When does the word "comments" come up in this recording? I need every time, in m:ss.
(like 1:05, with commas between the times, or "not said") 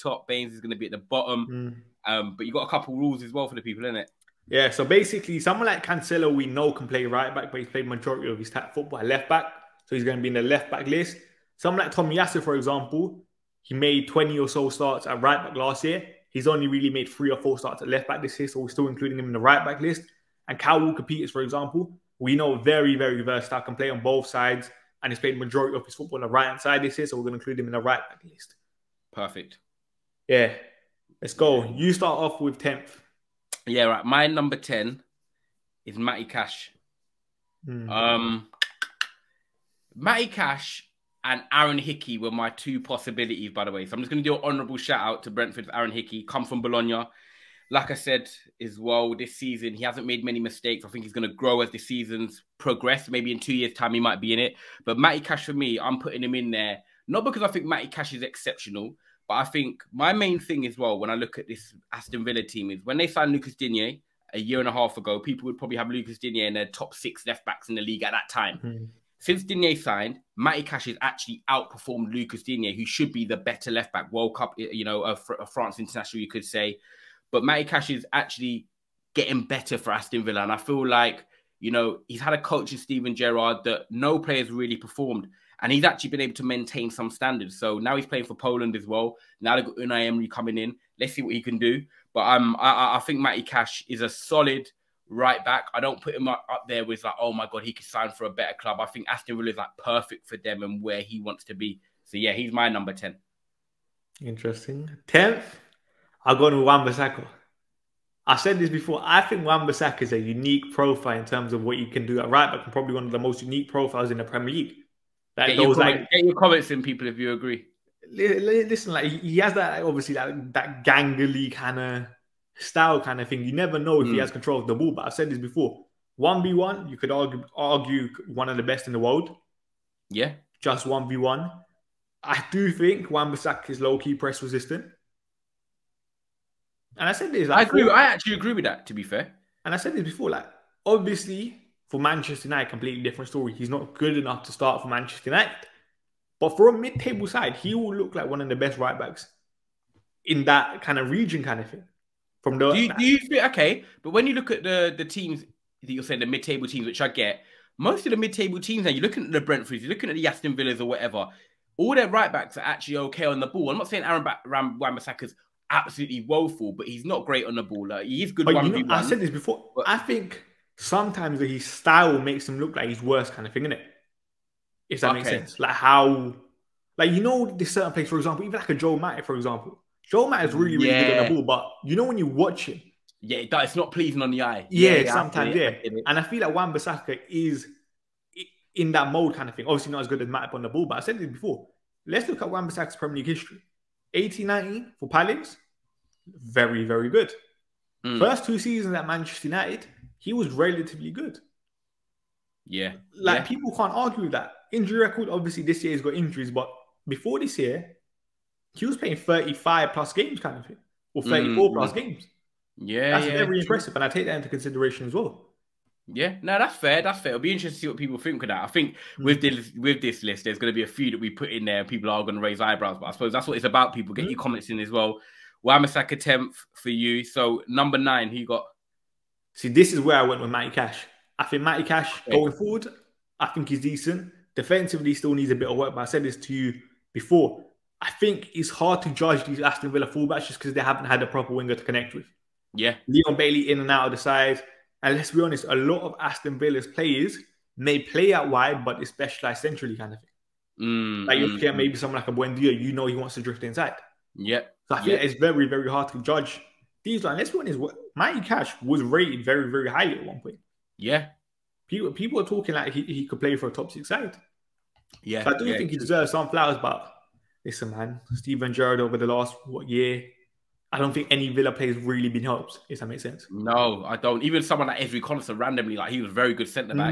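1:56, 3:44.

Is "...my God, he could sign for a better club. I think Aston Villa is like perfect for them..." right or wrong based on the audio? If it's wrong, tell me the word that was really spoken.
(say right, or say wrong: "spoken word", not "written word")
right.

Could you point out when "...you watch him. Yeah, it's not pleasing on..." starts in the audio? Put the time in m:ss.
3:02.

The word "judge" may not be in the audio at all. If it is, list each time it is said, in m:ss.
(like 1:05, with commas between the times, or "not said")
3:59, 4:16.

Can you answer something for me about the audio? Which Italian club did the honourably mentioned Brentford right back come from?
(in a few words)
Bologna.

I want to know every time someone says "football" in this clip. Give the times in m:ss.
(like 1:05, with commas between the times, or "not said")
0:08, 0:25.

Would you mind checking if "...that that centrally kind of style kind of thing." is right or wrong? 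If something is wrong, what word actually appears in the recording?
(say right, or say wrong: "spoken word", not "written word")
wrong: "gangly", not "centrally".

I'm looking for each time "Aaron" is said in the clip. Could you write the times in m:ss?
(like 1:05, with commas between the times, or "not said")
0:41, 0:45, 2:44.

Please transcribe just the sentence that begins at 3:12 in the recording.
Let's look at Wan Bissaka's Premier League history.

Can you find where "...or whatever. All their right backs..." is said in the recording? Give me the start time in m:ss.
2:40.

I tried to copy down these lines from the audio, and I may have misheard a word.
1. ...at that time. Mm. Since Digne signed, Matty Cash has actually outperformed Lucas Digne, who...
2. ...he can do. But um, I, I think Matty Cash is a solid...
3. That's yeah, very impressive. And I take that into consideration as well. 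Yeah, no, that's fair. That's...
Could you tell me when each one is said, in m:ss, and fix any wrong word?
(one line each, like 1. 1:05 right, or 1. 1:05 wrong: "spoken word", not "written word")
1. 1:08 right
2. 1:31 right
3. 3:33 right.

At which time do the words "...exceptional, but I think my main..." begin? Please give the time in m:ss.
0:58.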